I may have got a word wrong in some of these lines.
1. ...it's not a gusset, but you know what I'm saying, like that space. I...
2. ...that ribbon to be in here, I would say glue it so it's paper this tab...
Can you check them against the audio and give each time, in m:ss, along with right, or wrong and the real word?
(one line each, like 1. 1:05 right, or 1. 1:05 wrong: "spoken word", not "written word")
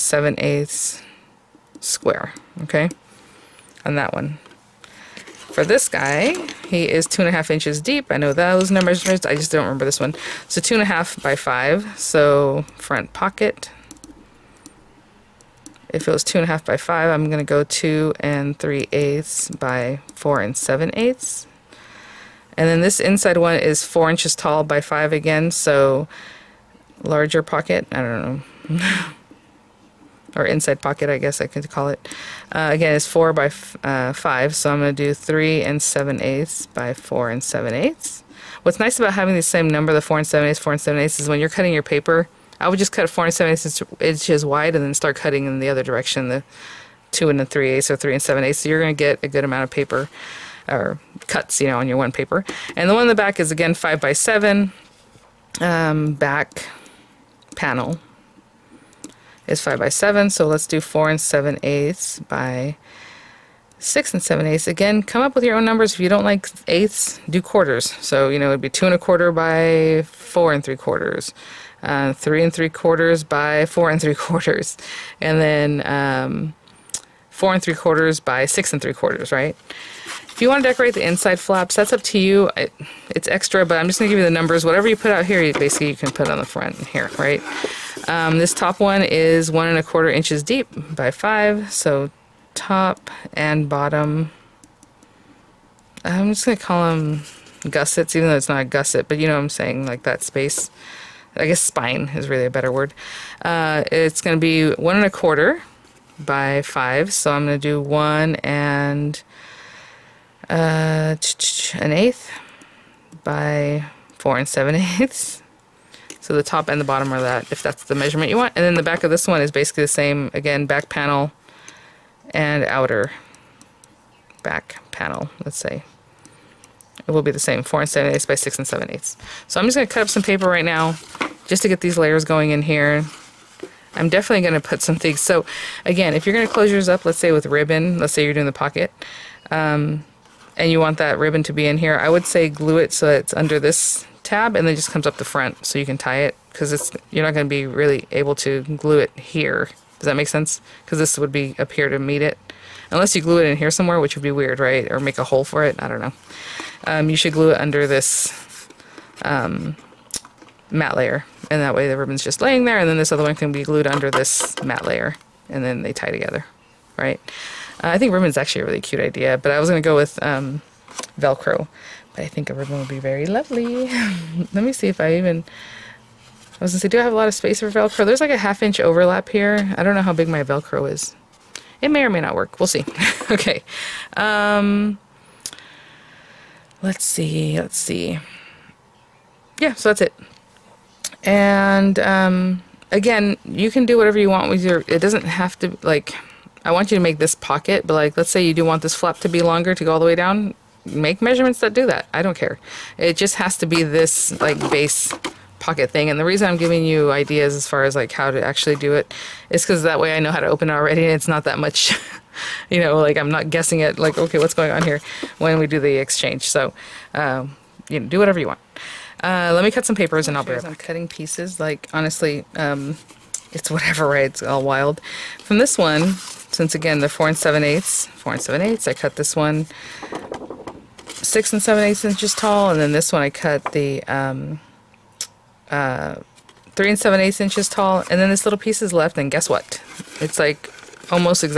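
1. 1:38 right
2. 2:20 wrong: "under", not "paper".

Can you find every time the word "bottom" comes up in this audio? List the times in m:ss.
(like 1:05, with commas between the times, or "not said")
1:33, 1:56.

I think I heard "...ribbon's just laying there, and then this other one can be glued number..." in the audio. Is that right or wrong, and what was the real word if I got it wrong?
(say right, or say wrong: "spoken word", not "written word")
wrong: "under", not "number".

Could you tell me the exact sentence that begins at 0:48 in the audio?
So you're going to get a good amount of paper or cuts, you know, on your one paper.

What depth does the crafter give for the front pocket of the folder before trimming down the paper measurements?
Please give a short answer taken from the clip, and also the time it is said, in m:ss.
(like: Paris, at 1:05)
2 1/2 inches, at 0:07.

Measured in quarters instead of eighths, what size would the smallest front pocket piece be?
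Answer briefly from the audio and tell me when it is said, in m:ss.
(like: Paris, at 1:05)
2 1/4 by 4 3/4, at 1:08.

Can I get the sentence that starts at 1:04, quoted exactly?
Again, come up with your own numbers.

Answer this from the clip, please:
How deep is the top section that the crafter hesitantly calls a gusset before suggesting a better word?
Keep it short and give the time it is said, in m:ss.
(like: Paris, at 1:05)
1 1/4 inches, at 1:29.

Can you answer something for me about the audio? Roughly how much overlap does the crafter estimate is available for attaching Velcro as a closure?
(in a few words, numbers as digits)
Half inch.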